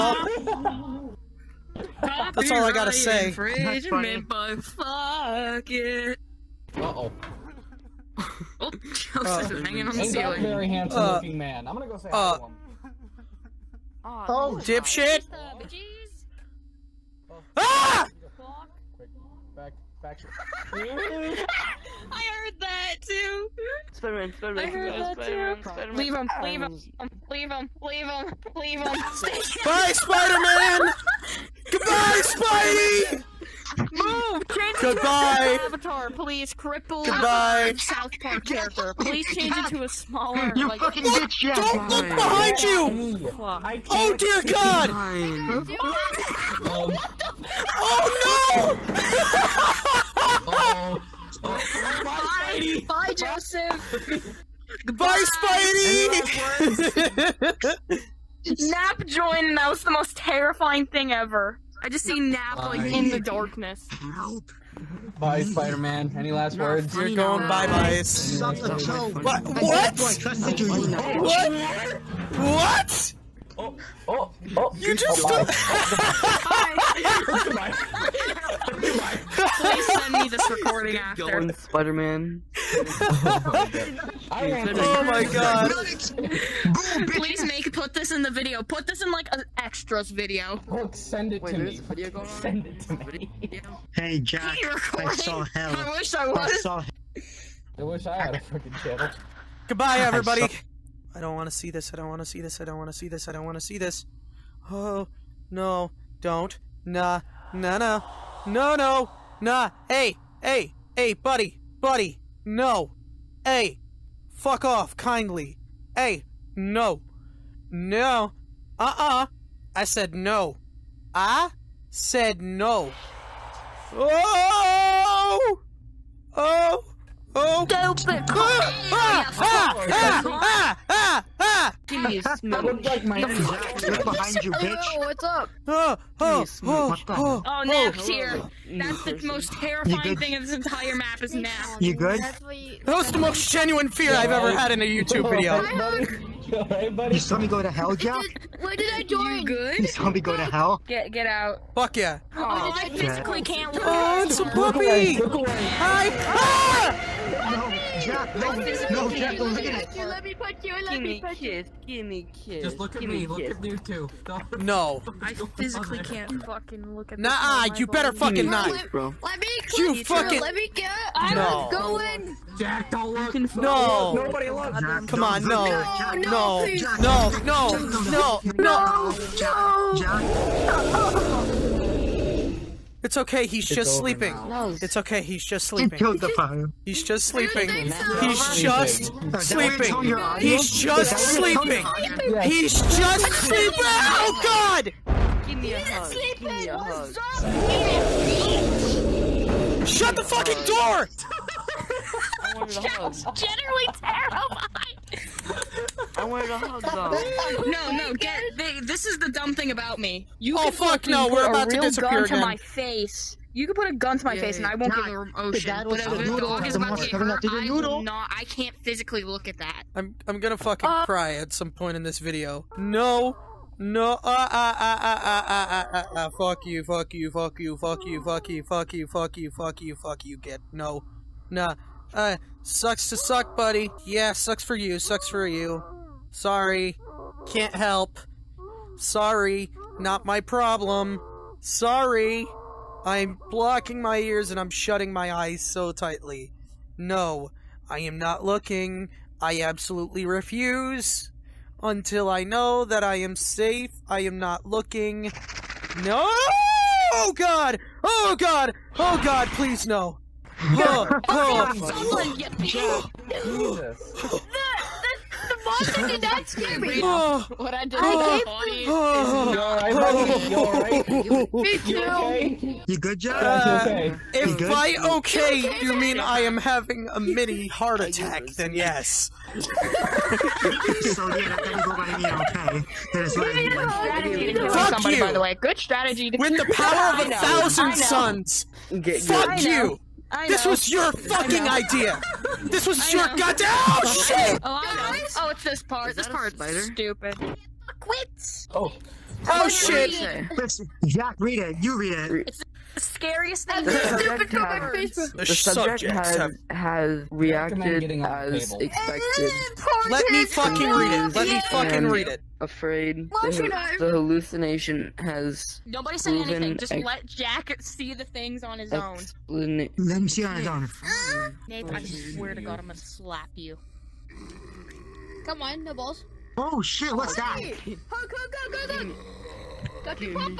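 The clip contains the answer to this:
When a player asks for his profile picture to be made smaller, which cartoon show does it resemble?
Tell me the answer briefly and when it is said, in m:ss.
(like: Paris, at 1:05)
South Park, at 0:37.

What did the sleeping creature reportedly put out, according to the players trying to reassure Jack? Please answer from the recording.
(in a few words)
the fire.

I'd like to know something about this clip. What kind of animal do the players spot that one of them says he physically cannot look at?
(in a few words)
puppy.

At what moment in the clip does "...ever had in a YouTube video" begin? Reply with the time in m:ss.
2:24.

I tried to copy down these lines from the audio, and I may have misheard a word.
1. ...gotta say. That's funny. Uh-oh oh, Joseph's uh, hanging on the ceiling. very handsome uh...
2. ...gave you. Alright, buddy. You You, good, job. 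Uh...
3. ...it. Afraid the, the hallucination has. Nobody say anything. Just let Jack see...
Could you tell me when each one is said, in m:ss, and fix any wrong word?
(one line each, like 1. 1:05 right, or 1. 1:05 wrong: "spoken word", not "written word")
1. 0:02 right
2. 4:28 right
3. 5:12 right.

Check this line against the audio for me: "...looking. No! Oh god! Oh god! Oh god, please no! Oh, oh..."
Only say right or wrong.
right.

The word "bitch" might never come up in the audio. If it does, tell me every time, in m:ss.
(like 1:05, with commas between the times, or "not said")
0:41, 2:14.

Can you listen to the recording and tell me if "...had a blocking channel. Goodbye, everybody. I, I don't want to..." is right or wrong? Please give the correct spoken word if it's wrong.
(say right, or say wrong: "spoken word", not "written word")
wrong: "fucking", not "blocking".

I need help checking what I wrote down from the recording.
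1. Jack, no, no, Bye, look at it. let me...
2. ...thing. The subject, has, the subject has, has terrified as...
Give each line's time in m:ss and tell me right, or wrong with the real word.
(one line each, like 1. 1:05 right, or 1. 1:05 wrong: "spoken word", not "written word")
1. 2:38 wrong: "Jack", not "Bye"
2. 5:03 wrong: "reacted", not "terrified".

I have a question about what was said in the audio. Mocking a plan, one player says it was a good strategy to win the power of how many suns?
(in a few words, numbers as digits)
1000.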